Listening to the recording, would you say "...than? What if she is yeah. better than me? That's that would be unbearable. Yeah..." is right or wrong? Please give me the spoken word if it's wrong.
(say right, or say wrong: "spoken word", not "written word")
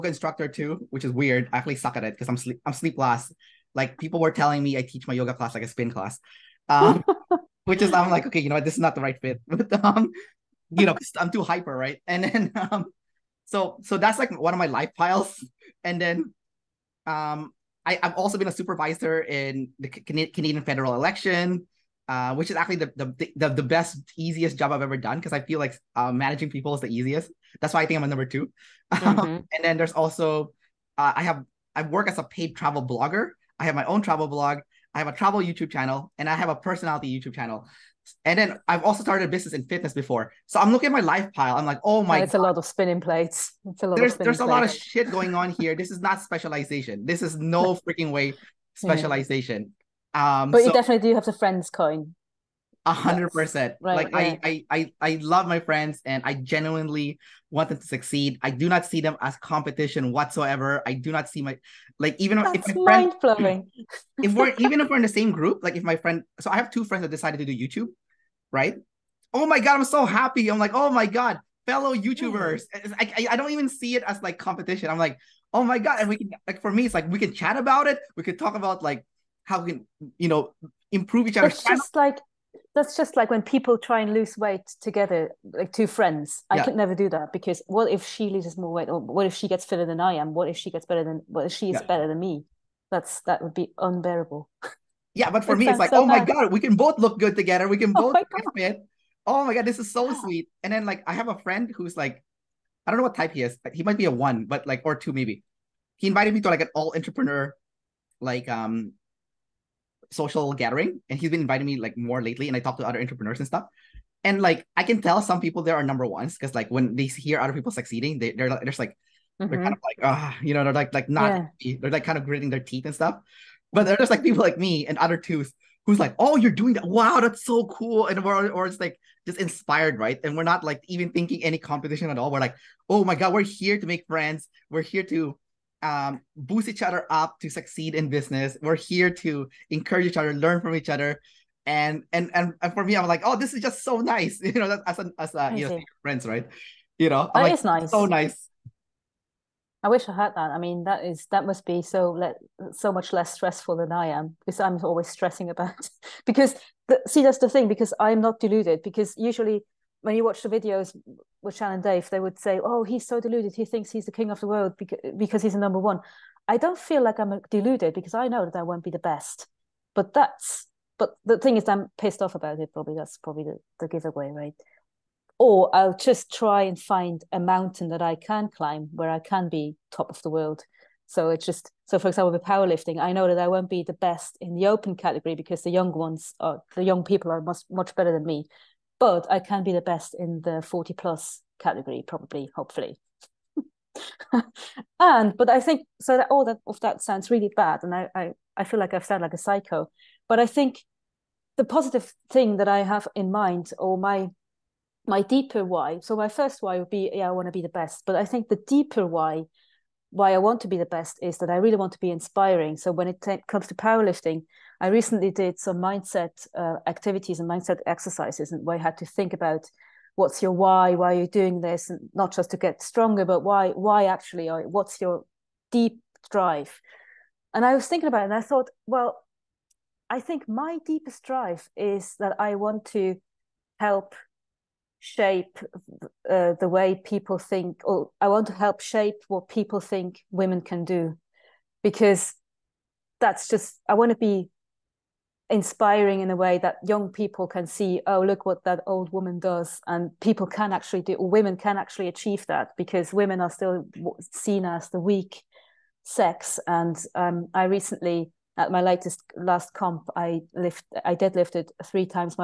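right.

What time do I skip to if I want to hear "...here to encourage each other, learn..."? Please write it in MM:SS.
02:18.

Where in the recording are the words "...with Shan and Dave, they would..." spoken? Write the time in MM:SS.
02:41.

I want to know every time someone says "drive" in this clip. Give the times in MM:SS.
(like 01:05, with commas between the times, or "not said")
03:46, 03:51.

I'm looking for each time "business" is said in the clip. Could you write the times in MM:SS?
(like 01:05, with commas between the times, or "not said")
00:39, 02:18.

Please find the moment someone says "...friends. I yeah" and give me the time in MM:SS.
01:25.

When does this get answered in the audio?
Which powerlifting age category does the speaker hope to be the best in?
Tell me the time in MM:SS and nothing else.
03:10.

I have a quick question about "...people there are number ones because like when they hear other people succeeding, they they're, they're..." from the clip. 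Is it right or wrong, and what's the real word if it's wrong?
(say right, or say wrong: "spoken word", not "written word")
right.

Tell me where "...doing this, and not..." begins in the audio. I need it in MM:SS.
03:41.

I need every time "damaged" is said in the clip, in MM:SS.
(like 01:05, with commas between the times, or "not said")
not said.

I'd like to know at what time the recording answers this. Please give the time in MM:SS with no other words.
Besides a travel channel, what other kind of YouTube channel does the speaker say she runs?
00:36.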